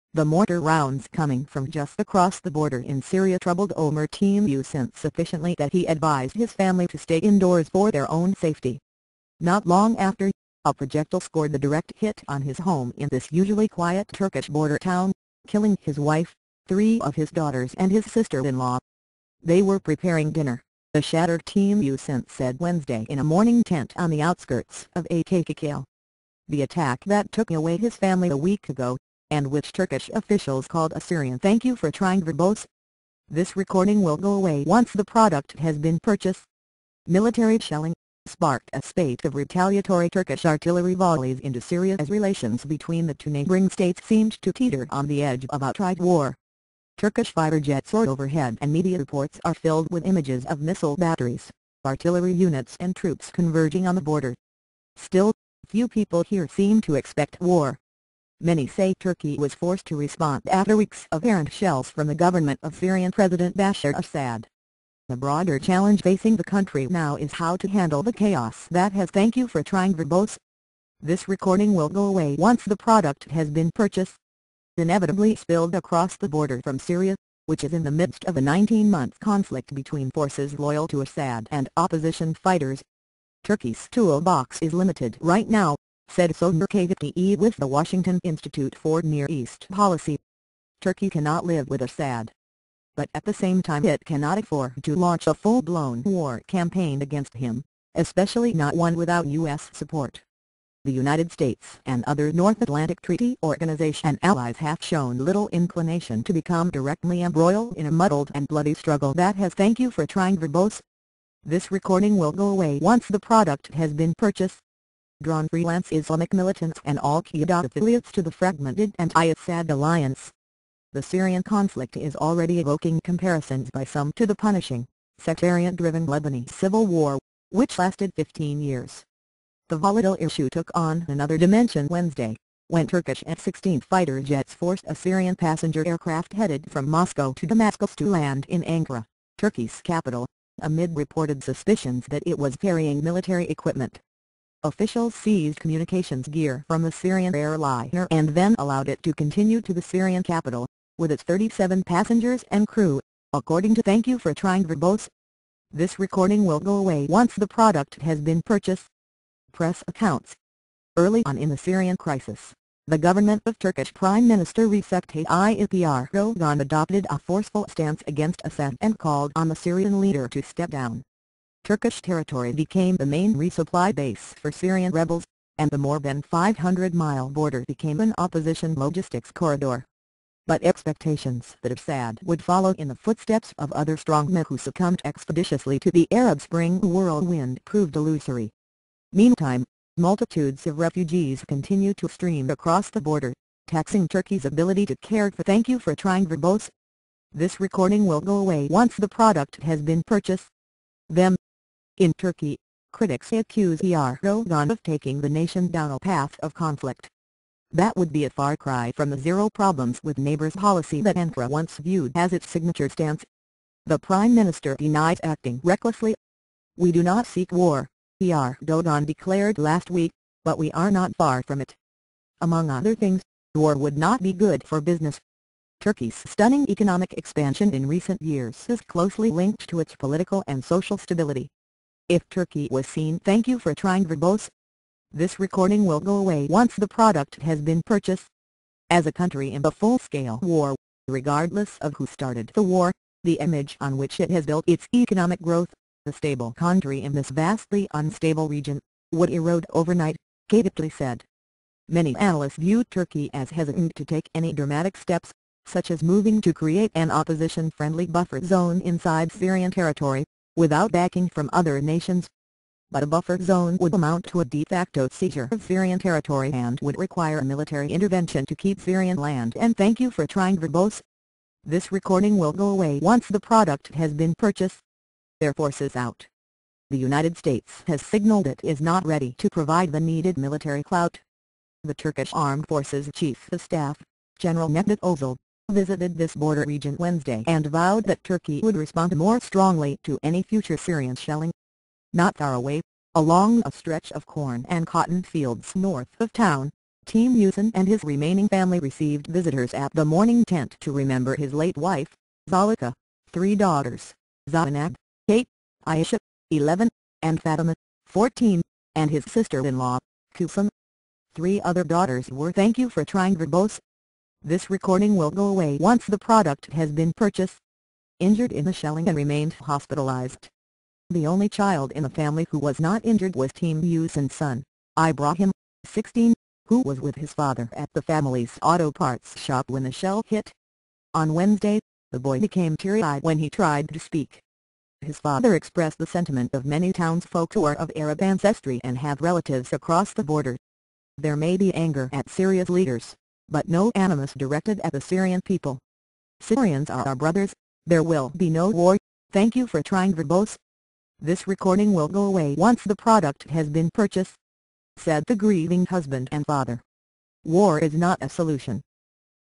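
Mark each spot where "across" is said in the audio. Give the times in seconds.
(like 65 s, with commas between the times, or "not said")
1 s, 75 s, 192 s, 339 s.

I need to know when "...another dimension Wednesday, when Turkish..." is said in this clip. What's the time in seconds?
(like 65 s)
131 s.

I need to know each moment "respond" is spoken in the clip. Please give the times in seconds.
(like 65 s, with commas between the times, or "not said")
59 s, 288 s.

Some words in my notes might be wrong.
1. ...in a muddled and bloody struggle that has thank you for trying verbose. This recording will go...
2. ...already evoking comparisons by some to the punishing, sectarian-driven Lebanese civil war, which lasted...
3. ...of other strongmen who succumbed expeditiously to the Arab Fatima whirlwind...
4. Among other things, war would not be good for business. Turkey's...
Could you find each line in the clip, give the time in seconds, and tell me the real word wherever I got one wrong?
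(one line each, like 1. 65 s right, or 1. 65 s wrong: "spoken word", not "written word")
1. 107 s right
2. 122 s right
3. 183 s wrong: "Spring", not "Fatima"
4. 222 s right.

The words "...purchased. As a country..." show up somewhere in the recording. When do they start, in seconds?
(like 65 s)
237 s.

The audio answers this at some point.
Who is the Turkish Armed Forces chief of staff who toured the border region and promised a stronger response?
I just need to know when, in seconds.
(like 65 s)
284 s.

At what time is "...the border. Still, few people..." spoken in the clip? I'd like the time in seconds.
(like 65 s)
53 s.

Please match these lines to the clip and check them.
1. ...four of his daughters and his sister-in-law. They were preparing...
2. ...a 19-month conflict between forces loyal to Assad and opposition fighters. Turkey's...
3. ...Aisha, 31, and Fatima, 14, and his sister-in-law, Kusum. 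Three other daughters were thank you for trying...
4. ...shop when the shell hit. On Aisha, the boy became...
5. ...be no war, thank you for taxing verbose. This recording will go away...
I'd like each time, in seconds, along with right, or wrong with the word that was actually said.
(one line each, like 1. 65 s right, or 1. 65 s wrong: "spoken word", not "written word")
1. 16 s wrong: "three", not "four"
2. 78 s right
3. 305 s wrong: "11", not "31"
4. 329 s wrong: "Wednesday", not "Aisha"
5. 348 s wrong: "trying", not "taxing".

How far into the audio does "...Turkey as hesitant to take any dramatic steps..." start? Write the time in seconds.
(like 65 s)
252 s.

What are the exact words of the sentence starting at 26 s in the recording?
The attack that took away his family a week ago and which Turkish officials called a Syrian thank you for trying verbose.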